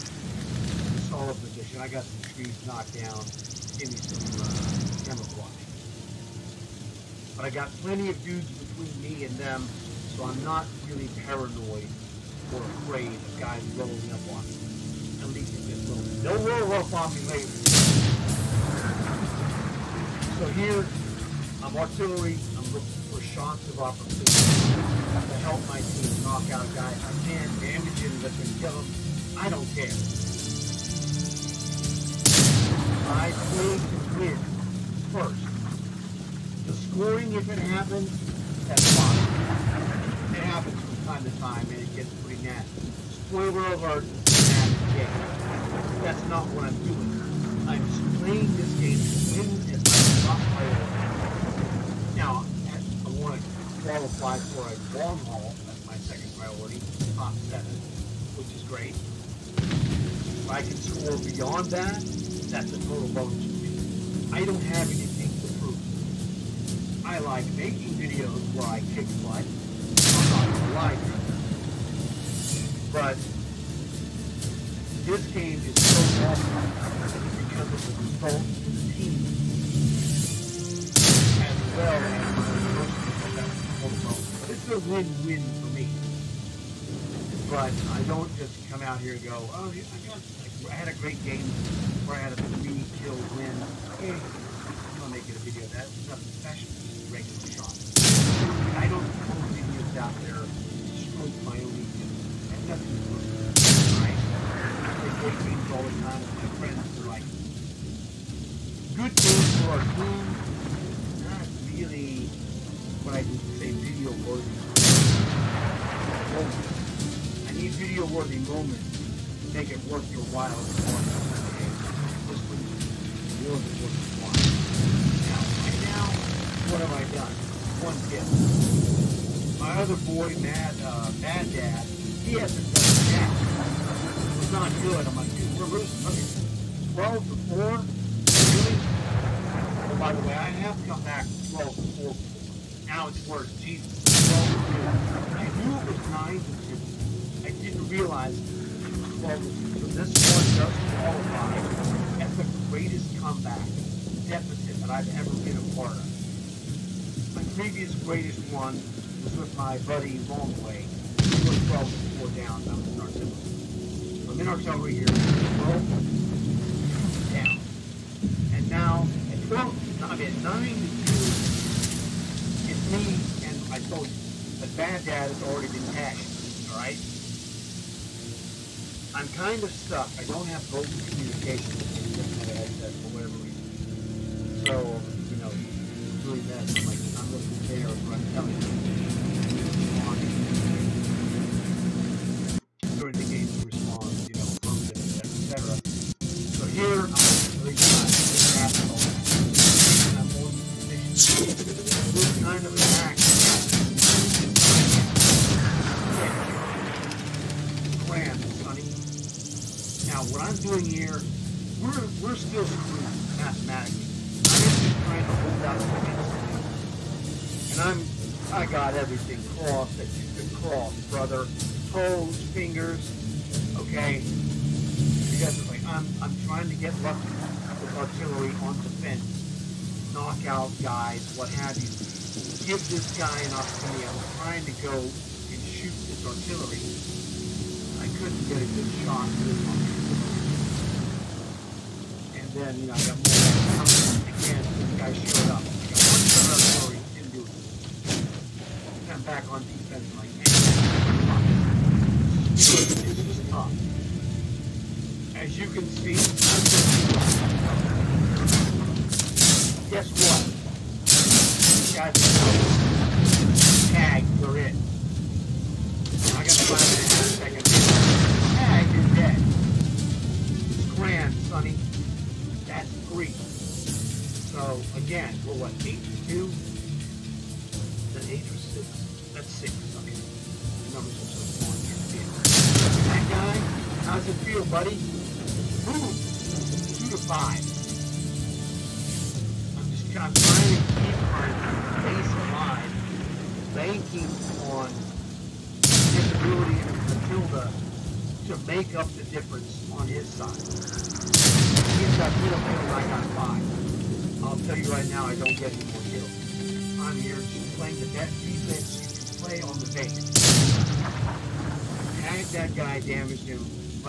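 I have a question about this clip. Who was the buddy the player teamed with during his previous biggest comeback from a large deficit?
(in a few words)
Longway.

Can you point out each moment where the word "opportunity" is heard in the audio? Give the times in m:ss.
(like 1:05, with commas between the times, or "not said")
0:23, 3:53.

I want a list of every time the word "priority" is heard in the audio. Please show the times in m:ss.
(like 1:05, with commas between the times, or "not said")
0:50, 0:56.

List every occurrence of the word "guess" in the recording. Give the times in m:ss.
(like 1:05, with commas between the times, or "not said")
4:19.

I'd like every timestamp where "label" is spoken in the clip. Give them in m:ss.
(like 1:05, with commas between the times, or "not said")
not said.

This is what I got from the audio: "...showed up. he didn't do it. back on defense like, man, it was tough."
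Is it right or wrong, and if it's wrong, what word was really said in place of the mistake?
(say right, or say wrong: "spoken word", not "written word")
right.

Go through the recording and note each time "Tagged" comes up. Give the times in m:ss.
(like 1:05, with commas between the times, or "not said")
5:12.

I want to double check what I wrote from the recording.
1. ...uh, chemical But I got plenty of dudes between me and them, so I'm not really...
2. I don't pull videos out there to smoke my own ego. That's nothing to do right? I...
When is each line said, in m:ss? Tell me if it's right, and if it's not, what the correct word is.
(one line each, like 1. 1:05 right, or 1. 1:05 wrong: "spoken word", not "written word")
1. 0:04 right
2. 1:38 right.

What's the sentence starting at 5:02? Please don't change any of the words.
He's got middle, middle, I got five.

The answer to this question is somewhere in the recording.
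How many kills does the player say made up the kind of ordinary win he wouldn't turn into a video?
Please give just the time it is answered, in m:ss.
1:32.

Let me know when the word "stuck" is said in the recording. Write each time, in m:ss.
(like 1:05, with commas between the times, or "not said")
2:59.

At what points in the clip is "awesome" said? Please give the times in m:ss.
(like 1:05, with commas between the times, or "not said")
1:16.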